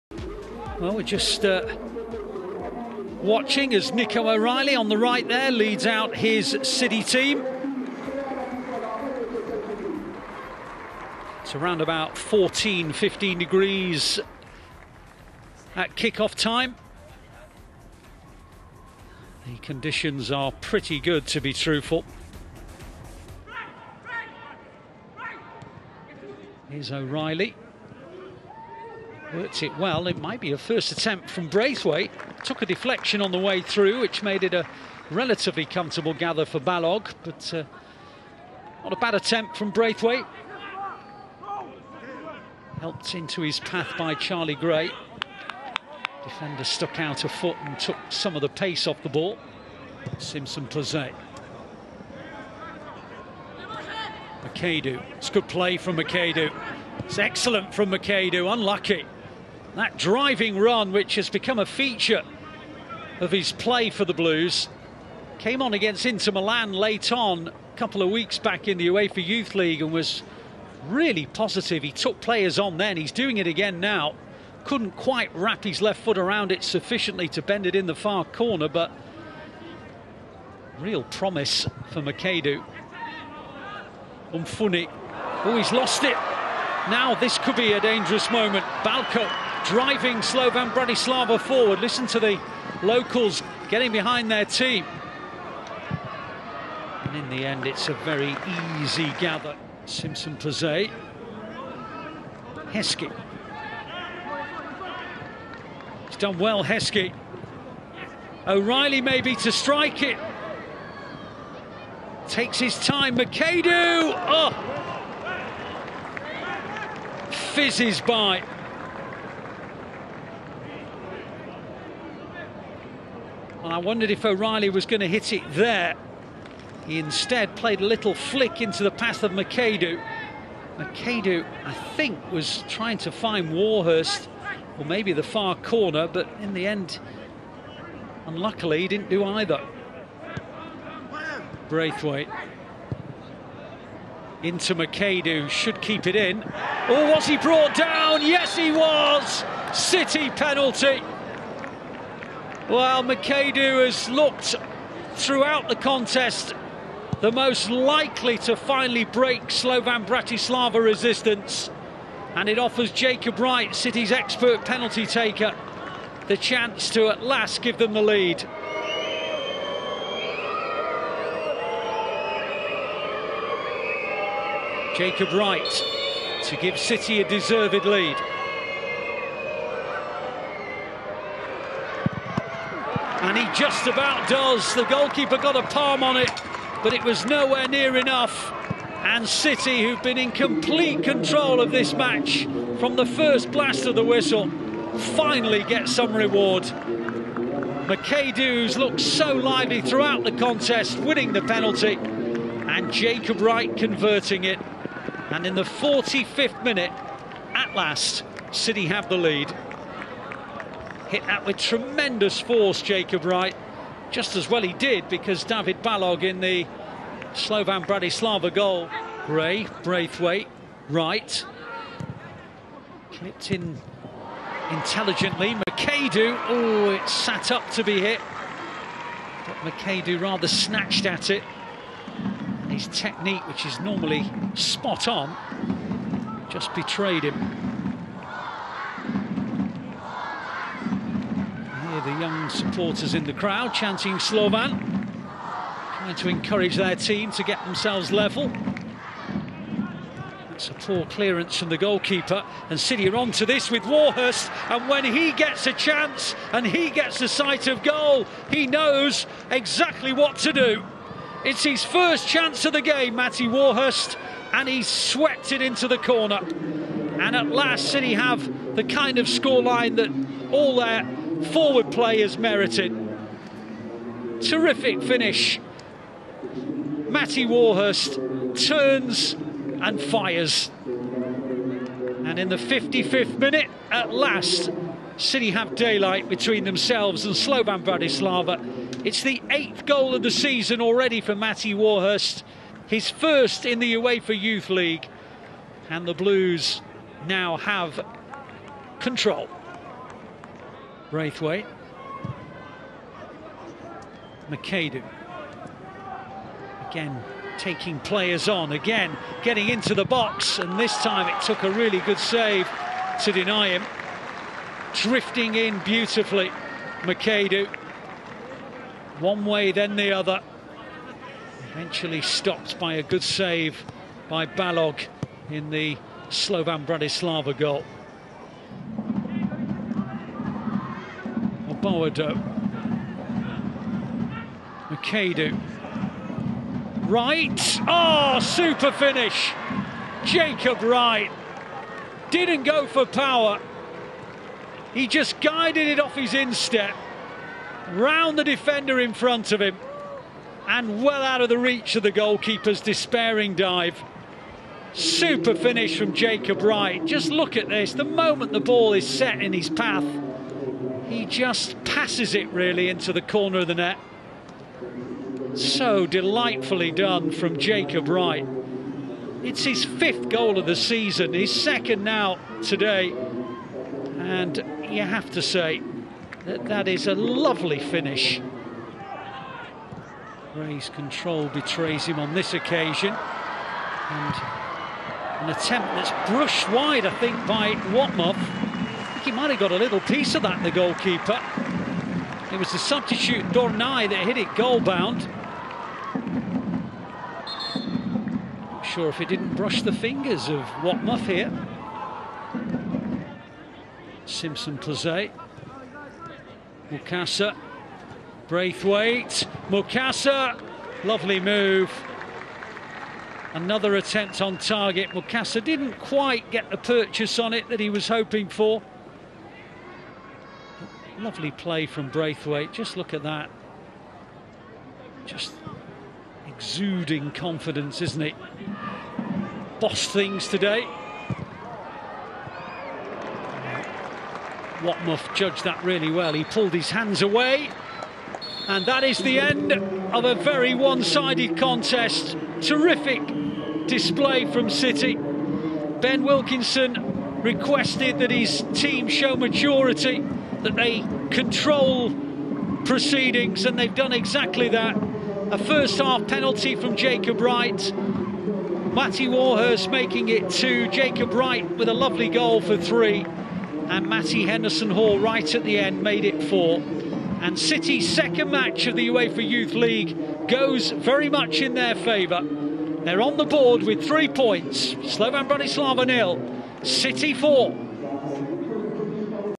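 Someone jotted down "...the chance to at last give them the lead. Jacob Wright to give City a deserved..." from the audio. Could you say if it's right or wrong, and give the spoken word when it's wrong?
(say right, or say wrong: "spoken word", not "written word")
right.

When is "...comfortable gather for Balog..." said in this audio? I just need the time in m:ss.
0:35.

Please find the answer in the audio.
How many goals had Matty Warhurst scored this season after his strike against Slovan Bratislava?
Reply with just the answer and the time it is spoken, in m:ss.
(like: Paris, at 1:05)
8, at 4:49.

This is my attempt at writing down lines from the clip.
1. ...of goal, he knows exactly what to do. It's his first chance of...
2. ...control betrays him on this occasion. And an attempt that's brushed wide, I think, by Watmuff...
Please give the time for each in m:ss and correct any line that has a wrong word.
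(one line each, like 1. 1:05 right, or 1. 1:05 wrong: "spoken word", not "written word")
1. 4:17 right
2. 6:20 right.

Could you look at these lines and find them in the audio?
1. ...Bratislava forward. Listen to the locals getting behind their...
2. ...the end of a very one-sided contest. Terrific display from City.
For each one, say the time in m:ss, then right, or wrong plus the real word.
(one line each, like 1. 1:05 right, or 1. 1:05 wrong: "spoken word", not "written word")
1. 1:30 right
2. 7:19 right.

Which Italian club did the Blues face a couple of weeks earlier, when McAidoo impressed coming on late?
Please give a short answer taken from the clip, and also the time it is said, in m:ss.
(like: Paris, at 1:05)
Inter Milan, at 1:06.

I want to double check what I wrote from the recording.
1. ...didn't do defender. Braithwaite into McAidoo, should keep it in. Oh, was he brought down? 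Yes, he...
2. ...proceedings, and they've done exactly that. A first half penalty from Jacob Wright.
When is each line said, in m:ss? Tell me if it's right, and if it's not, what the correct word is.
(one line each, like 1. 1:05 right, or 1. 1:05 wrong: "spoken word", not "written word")
1. 2:18 wrong: "either", not "defender"
2. 7:32 right.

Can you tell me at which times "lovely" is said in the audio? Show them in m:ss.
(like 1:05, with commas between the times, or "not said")
6:17, 6:51, 7:01, 7:41.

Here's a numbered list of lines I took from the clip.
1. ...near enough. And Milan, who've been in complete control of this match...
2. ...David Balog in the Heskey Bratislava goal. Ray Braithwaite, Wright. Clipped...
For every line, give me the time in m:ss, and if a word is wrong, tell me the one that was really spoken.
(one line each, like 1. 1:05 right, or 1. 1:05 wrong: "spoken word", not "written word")
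1. 3:07 wrong: "City", not "Milan"
2. 3:35 wrong: "Slovan", not "Heskey".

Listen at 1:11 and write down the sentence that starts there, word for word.
He took players on then, he's doing it again now.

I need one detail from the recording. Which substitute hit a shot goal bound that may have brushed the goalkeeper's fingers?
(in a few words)
Dornay.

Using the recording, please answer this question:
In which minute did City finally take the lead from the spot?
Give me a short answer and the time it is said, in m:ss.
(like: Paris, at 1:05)
45th, at 3:25.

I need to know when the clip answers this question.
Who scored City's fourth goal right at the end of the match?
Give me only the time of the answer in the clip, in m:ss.
7:44.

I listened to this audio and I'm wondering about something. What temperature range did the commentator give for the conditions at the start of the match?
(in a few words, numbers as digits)
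14-15 degrees.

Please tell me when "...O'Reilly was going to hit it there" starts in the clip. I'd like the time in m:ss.
2:04.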